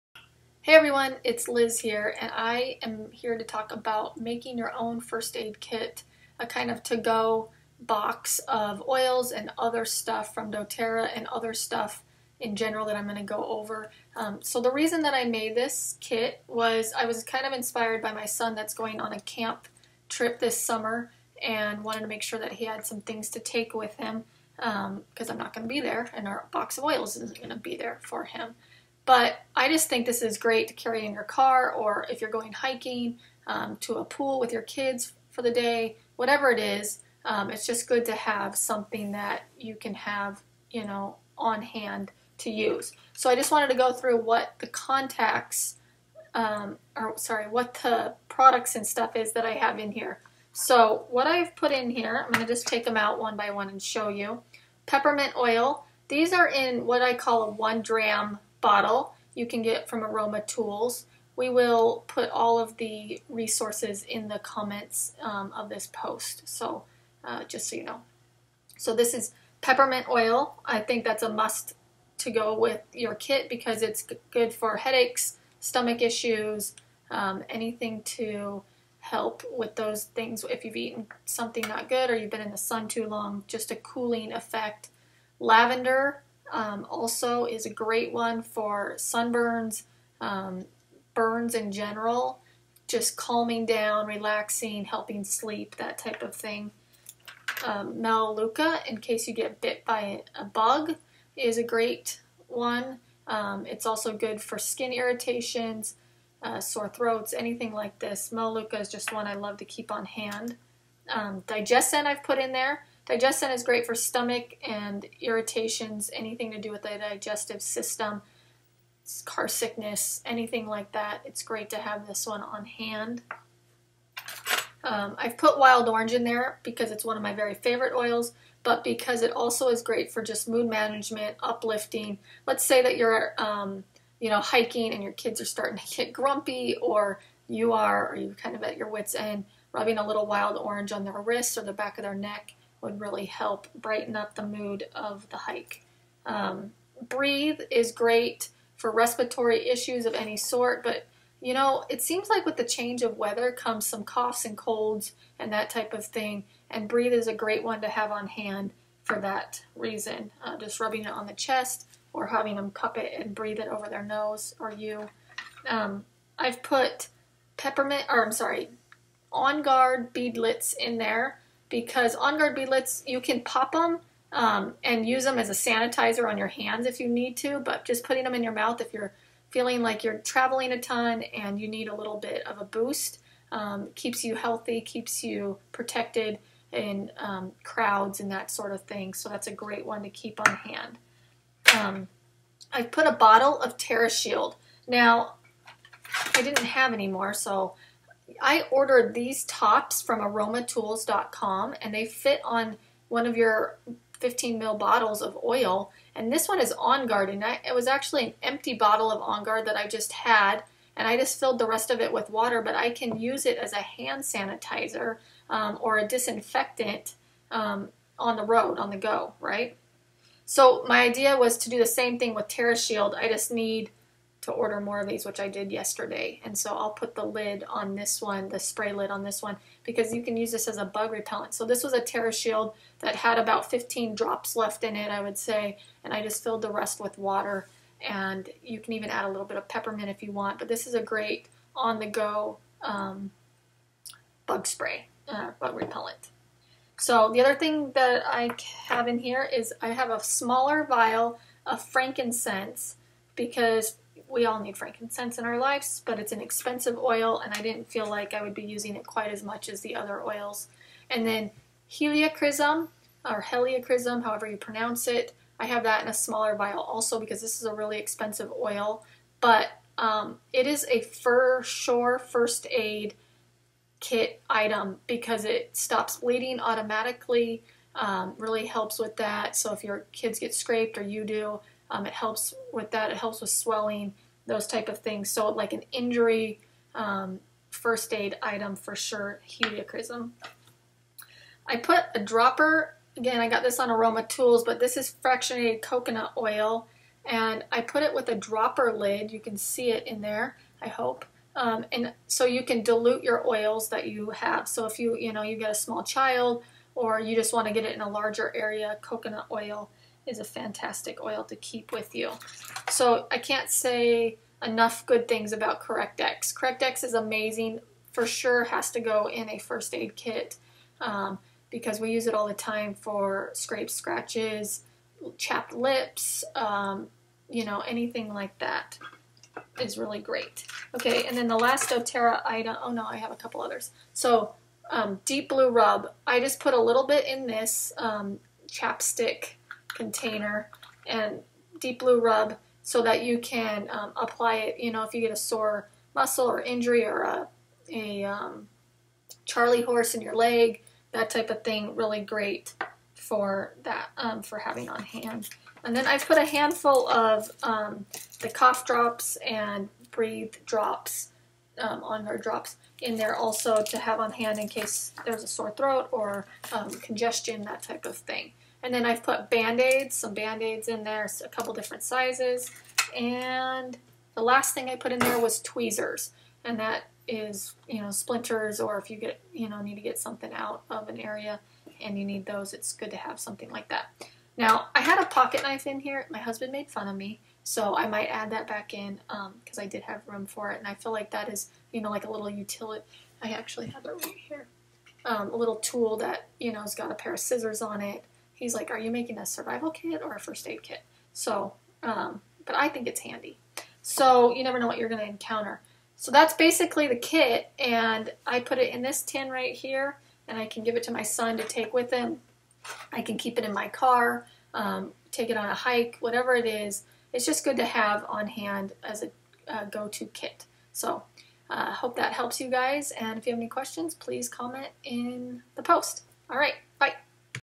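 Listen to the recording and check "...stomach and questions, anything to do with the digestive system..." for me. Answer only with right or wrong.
wrong.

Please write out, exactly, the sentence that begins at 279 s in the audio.
So if your kids get scraped or you do, um, it helps with that.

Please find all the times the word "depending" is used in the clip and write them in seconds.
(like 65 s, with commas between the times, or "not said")
not said.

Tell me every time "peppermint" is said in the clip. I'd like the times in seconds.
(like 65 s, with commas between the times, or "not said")
54 s, 69 s, 167 s, 239 s.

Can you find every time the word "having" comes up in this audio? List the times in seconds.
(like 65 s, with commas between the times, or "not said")
162 s, 354 s.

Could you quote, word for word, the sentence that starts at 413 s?
I can keep it in my car, um, take it on a hike, whatever it is.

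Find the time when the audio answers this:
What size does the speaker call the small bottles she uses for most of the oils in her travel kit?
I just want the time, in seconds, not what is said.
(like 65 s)
57 s.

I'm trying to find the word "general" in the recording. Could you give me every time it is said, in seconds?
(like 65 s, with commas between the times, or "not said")
12 s, 91 s.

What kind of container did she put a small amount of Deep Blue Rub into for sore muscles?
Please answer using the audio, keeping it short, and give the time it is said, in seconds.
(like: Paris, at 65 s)
chapstick container, at 338 s.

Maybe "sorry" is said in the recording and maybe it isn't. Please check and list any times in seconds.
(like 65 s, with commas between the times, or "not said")
47 s, 168 s.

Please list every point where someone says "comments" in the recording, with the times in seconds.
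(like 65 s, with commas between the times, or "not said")
64 s, 424 s.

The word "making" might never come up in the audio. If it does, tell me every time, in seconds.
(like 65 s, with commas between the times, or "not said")
4 s, 399 s.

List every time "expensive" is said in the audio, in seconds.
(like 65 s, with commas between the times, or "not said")
256 s, 267 s.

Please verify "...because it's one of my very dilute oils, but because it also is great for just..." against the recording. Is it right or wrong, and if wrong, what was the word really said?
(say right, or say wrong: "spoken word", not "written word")
wrong: "favorite", not "dilute".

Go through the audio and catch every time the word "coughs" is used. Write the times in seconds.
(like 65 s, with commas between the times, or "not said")
154 s, 358 s.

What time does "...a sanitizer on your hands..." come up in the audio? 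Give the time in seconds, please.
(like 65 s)
175 s.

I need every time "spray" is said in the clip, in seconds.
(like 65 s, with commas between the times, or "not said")
228 s, 244 s.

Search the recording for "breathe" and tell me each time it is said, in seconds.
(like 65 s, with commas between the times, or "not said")
147 s, 156 s, 163 s, 360 s.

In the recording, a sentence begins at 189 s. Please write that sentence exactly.
So that's a great one to keep on hand.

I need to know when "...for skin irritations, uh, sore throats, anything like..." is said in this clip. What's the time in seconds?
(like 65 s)
104 s.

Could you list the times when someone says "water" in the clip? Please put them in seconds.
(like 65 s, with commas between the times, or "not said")
212 s, 237 s.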